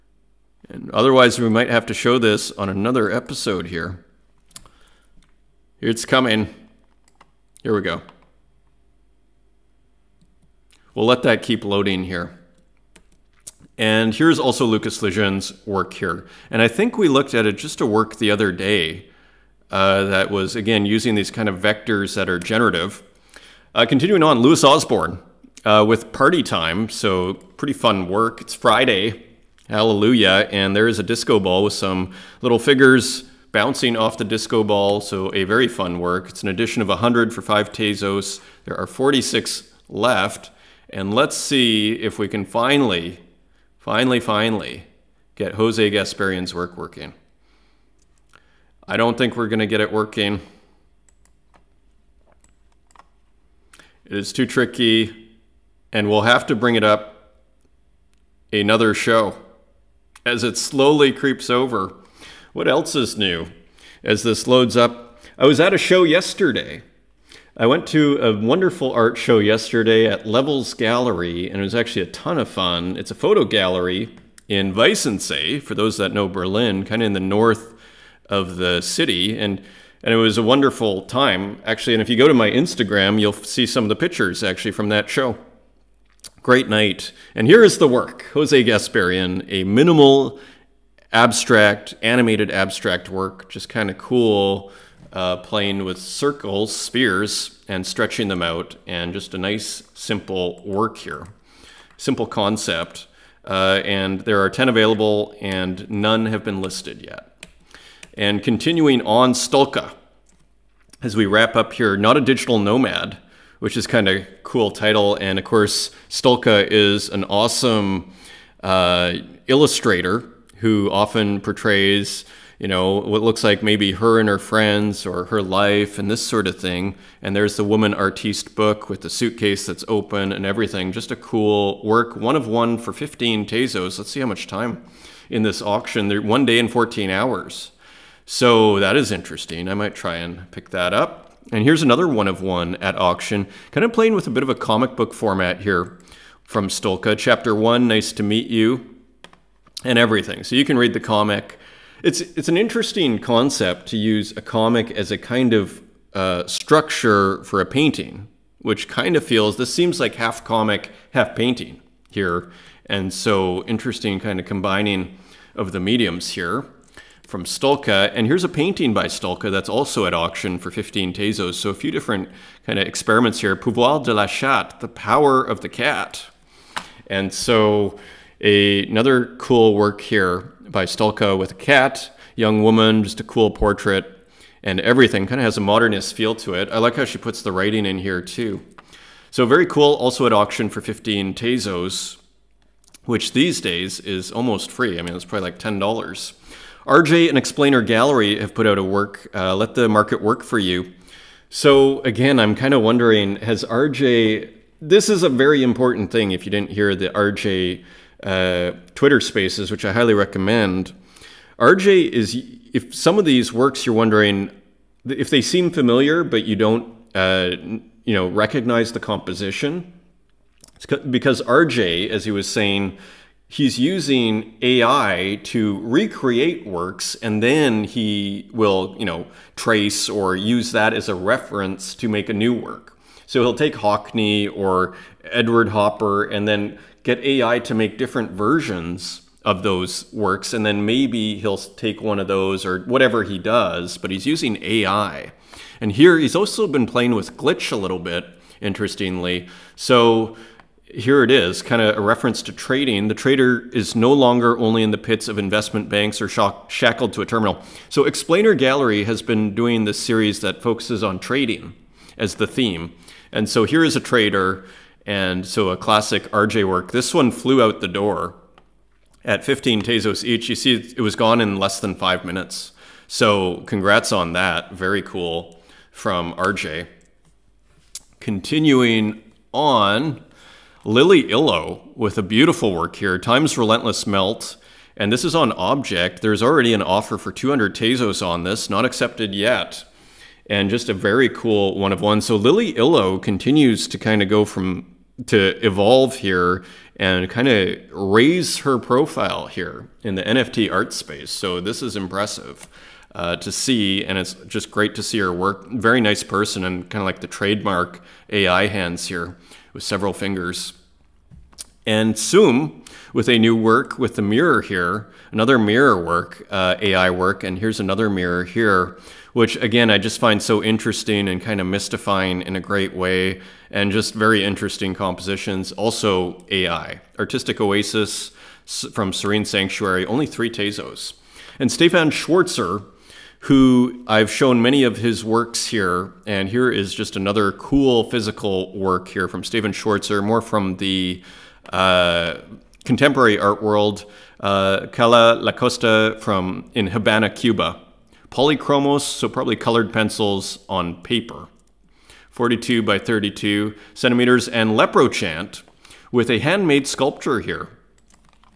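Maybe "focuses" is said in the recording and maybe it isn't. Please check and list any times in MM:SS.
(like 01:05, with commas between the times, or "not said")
04:20.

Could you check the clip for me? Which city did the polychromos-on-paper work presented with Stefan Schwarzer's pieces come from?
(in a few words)
Habana, Cuba.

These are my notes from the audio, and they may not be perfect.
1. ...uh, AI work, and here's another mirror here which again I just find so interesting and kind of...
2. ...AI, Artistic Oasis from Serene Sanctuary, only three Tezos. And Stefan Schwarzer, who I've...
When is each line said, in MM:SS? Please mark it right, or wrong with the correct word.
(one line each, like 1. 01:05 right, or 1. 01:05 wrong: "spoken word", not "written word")
1. 05:16 right
2. 05:26 right.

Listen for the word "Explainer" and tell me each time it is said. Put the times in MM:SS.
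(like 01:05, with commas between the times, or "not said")
03:17, 04:18.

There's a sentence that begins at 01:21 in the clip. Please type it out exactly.
And if you go to my Instagram, you'll see some of the pictures actually from that show.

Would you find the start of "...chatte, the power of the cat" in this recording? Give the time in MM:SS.
02:54.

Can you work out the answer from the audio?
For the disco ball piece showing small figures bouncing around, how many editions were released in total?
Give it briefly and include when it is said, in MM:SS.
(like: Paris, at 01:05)
100, at 00:36.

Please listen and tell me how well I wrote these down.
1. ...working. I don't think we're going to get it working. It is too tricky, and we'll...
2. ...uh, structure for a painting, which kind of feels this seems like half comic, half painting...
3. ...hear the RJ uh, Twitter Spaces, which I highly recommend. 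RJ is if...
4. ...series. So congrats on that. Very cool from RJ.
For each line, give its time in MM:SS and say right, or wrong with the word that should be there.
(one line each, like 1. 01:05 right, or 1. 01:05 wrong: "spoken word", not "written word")
1. 00:46 right
2. 02:36 right
3. 03:26 right
4. 04:32 wrong: "minutes", not "series".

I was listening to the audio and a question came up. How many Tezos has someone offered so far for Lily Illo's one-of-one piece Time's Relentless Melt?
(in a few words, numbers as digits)
200.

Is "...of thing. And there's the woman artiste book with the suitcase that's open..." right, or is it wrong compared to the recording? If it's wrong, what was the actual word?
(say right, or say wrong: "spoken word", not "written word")
right.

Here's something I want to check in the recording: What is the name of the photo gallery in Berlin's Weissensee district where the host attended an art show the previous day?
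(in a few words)
Levels Gallery.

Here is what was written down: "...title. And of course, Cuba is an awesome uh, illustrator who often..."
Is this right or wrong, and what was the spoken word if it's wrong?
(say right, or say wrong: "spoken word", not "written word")
wrong: "Stolka", not "Cuba".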